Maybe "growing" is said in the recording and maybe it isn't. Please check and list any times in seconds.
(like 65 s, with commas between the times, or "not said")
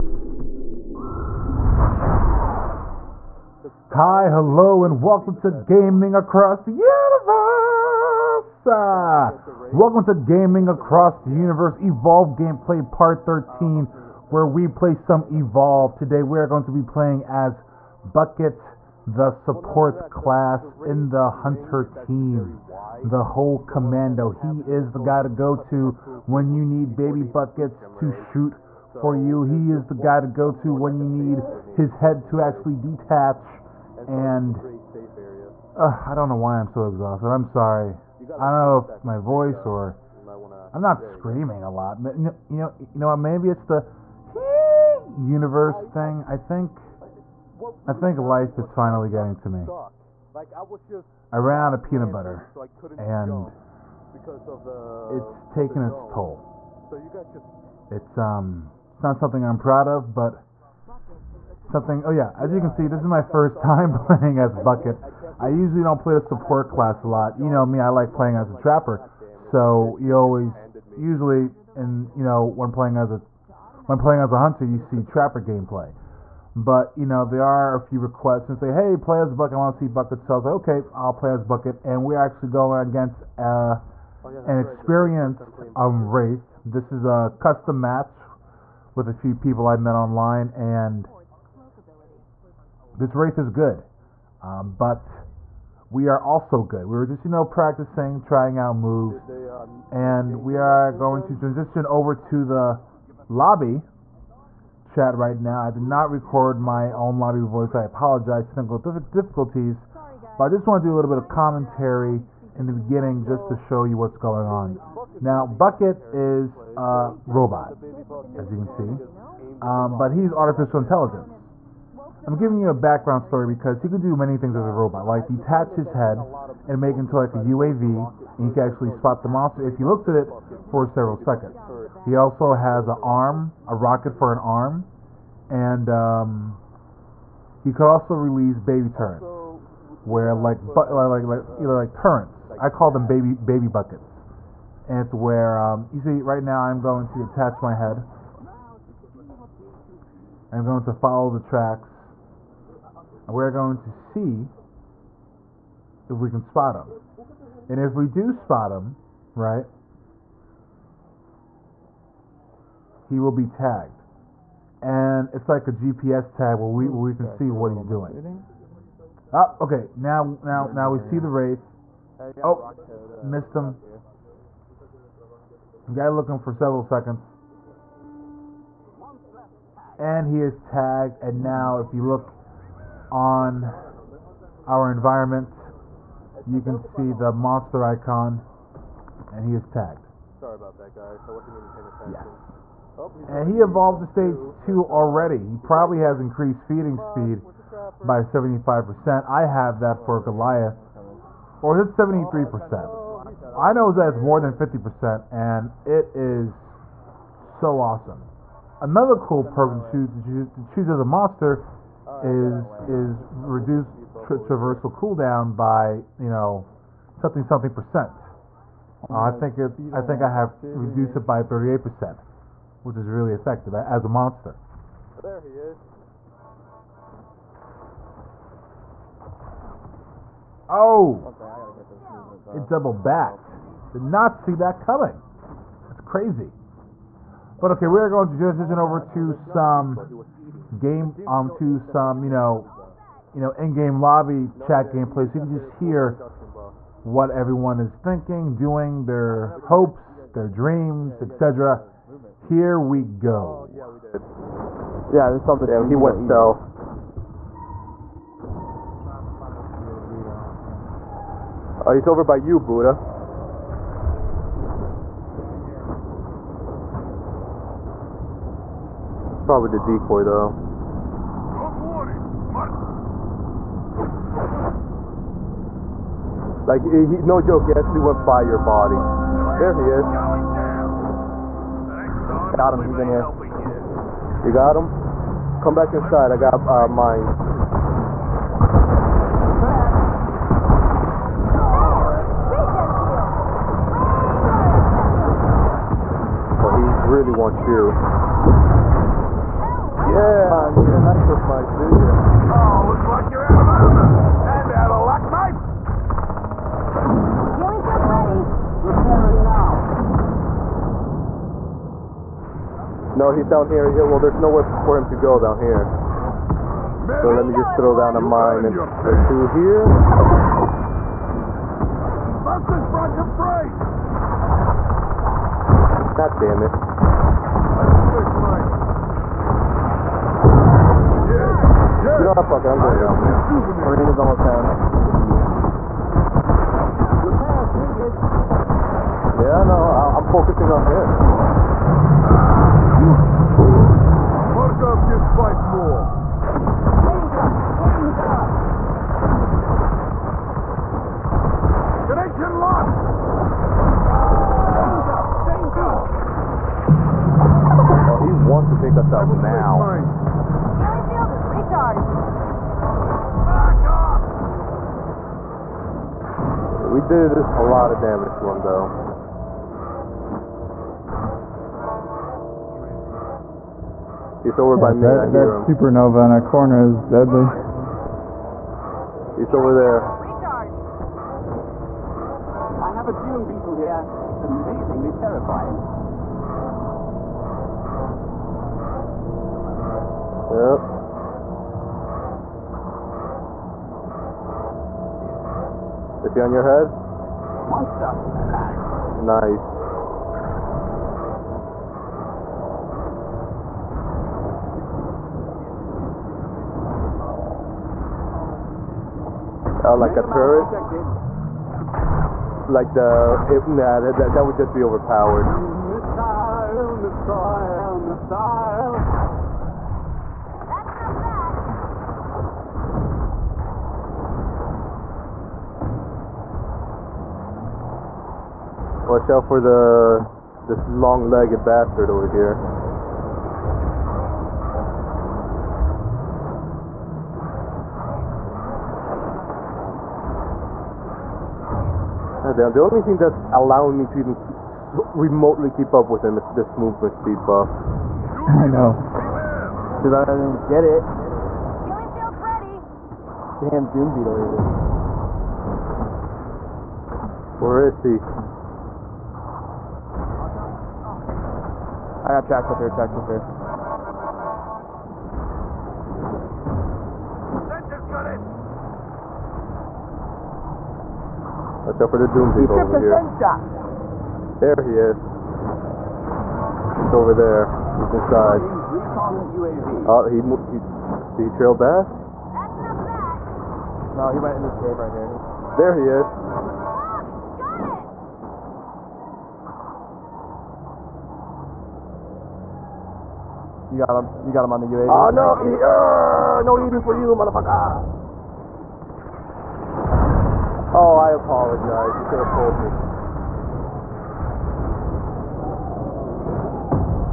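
not said.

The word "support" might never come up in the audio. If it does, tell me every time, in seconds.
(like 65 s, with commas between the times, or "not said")
19 s, 66 s.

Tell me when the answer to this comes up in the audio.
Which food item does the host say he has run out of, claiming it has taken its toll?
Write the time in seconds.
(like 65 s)
51 s.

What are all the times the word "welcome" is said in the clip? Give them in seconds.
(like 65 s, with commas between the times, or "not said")
5 s, 9 s.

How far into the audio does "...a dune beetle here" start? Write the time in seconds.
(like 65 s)
383 s.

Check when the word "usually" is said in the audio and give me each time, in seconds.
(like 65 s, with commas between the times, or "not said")
65 s, 70 s.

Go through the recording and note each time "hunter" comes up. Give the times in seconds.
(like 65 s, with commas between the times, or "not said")
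21 s, 74 s.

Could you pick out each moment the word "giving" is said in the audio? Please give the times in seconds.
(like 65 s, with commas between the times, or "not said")
122 s.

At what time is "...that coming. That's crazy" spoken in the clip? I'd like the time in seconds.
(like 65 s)
234 s.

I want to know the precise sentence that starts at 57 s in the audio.
It's um, it's not something I'm proud of, but something.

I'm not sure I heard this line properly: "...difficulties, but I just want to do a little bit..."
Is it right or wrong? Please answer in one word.
right.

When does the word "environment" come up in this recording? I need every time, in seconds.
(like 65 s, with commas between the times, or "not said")
184 s.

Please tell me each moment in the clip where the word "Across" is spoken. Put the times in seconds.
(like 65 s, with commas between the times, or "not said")
6 s, 10 s.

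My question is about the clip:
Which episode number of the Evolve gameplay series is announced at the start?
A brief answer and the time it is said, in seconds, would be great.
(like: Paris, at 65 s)
13, at 12 s.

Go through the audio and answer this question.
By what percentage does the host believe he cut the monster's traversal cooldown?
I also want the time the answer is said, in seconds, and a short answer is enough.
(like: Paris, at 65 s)
38 percent, at 221 s.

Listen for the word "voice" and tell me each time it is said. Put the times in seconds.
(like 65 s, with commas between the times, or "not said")
39 s, 107 s.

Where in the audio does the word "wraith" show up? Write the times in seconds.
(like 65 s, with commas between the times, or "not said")
86 s, 93 s, 171 s.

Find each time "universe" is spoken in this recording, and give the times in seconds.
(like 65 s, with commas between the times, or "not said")
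6 s, 11 s, 45 s.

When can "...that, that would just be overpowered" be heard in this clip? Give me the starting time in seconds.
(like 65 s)
414 s.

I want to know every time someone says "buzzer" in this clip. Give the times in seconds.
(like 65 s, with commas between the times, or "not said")
not said.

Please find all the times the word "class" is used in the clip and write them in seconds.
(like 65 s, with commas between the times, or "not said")
20 s, 66 s.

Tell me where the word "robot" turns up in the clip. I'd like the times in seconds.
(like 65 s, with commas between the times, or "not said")
117 s, 124 s.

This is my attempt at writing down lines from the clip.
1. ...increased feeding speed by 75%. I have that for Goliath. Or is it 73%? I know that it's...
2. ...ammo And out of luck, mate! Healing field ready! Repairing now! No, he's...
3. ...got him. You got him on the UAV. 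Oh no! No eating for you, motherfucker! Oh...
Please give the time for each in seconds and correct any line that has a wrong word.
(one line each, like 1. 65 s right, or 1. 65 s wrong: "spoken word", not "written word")
1. 196 s right
2. 303 s right
3. 494 s right.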